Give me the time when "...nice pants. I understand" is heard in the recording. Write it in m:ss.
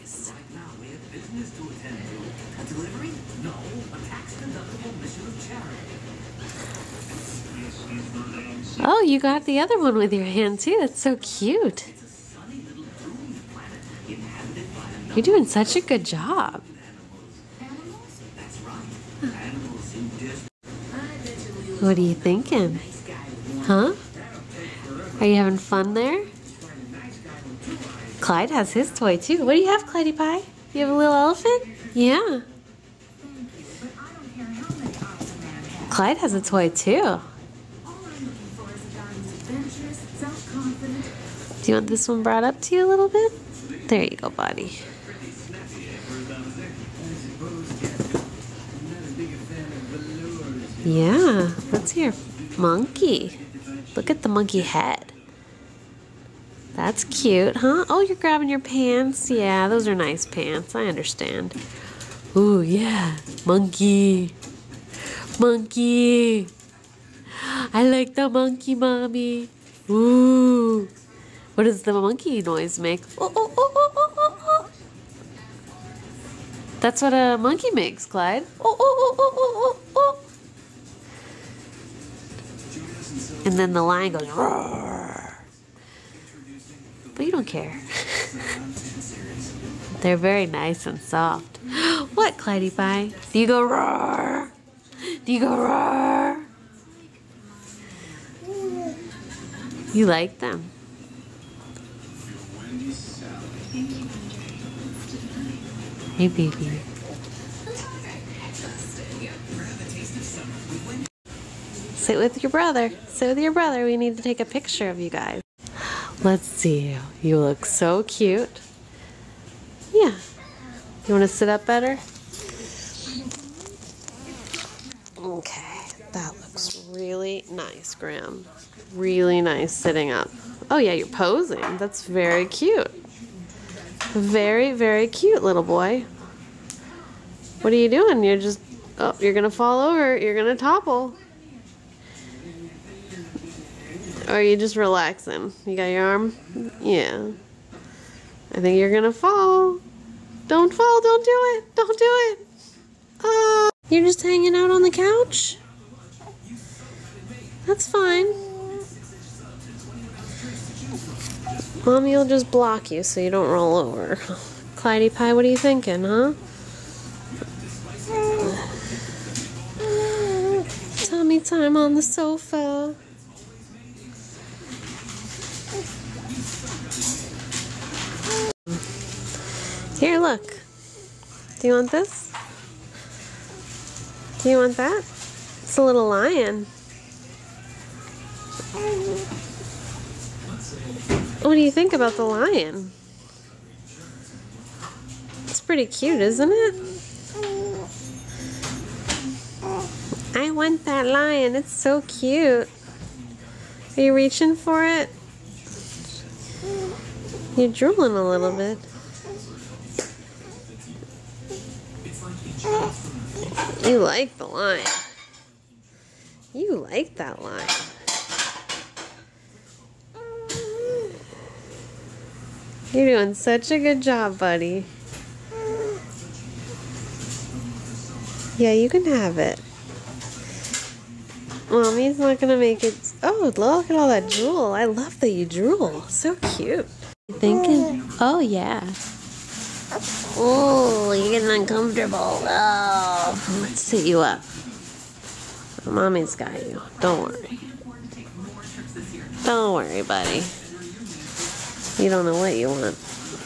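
0:59.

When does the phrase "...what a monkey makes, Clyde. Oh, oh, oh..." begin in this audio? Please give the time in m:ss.
1:17.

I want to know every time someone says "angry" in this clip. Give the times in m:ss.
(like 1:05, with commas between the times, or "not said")
not said.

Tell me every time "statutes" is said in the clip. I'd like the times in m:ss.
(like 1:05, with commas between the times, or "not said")
not said.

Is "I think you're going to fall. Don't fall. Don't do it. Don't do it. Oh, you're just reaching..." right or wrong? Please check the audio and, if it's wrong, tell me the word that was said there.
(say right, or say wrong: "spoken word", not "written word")
wrong: "hanging", not "reaching".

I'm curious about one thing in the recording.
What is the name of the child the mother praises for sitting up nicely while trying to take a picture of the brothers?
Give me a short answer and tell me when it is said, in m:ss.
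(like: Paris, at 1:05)
Graham, at 2:07.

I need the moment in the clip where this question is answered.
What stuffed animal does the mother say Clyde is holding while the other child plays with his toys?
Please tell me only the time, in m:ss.
0:31.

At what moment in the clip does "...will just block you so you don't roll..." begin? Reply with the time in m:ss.
2:42.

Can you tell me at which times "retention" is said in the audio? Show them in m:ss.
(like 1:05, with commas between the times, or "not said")
not said.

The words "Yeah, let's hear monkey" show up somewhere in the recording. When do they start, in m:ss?
0:50.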